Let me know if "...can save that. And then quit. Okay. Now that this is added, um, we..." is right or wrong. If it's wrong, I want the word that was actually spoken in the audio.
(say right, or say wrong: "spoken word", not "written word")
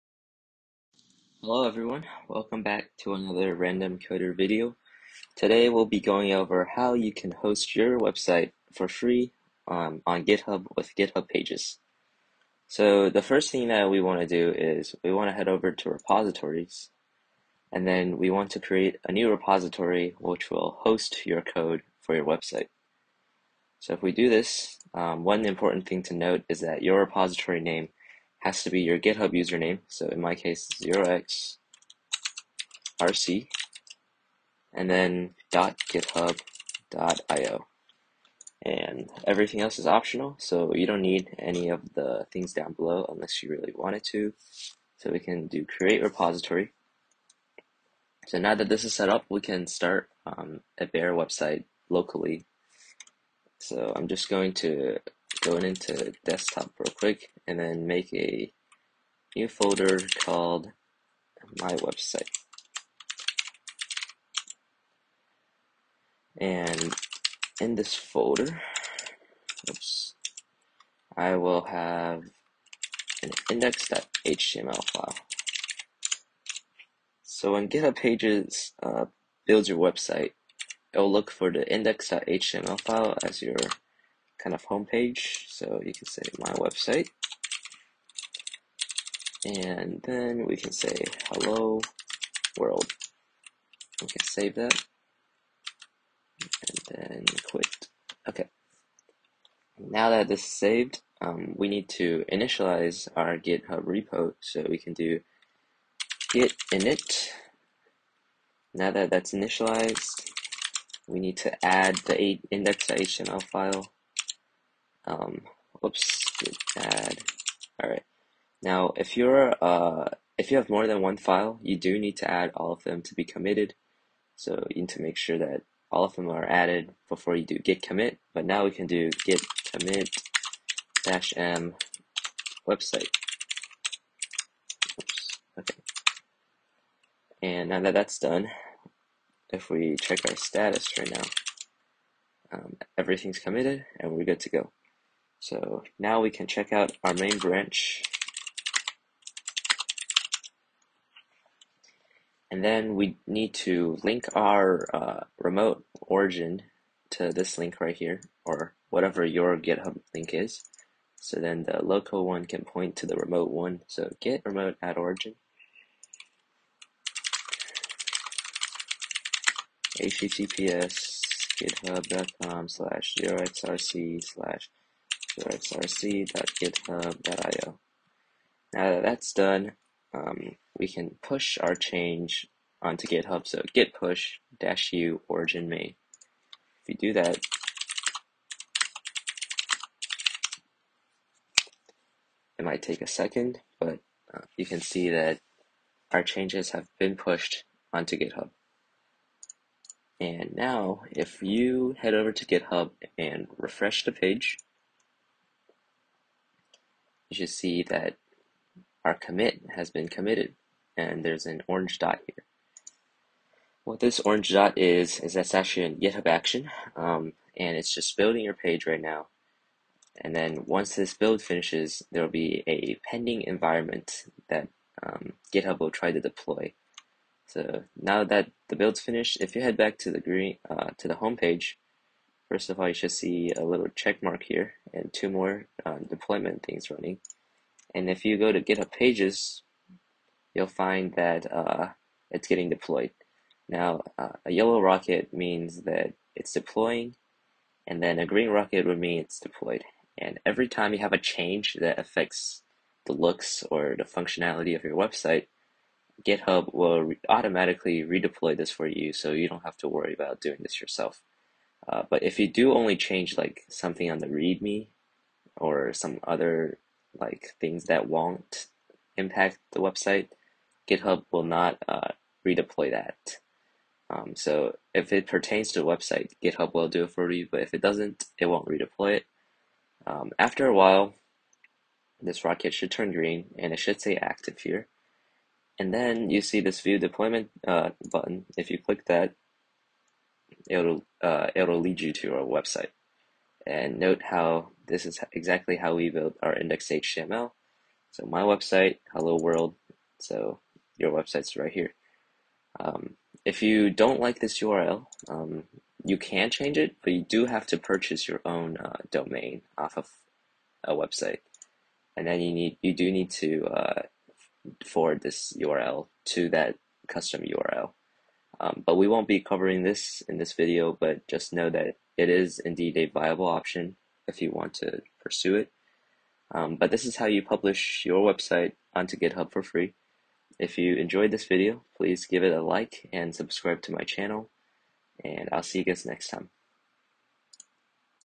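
wrong: "saved", not "added".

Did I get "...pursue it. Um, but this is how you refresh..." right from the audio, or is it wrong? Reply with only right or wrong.
wrong.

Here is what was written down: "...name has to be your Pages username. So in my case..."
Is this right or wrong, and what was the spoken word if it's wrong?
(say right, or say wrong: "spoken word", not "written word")
wrong: "GitHub", not "Pages".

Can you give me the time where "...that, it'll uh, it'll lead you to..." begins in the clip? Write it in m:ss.
4:49.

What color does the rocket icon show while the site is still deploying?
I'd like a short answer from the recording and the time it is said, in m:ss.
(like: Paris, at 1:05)
Yellow, at 4:04.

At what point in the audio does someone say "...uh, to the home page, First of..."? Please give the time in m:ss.
3:50.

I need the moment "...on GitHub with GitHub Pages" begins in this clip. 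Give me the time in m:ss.
0:10.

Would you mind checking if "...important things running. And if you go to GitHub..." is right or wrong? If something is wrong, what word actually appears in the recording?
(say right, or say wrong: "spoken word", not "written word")
wrong: "deployment", not "important".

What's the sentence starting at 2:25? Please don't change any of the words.
So now we can check out our main branch.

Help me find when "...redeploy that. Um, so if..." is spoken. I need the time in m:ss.
4:32.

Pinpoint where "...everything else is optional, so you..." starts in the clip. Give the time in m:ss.
0:39.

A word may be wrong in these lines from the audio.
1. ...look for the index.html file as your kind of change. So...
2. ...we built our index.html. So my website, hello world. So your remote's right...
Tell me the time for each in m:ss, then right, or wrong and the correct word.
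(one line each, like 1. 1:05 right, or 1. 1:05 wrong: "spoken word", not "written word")
1. 1:21 wrong: "homepage", not "change"
2. 4:55 wrong: "website", not "remote".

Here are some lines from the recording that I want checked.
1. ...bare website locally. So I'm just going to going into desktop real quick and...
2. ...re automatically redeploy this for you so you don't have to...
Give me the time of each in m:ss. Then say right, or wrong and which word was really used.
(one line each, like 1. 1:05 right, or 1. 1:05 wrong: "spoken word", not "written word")
1. 0:50 right
2. 4:17 right.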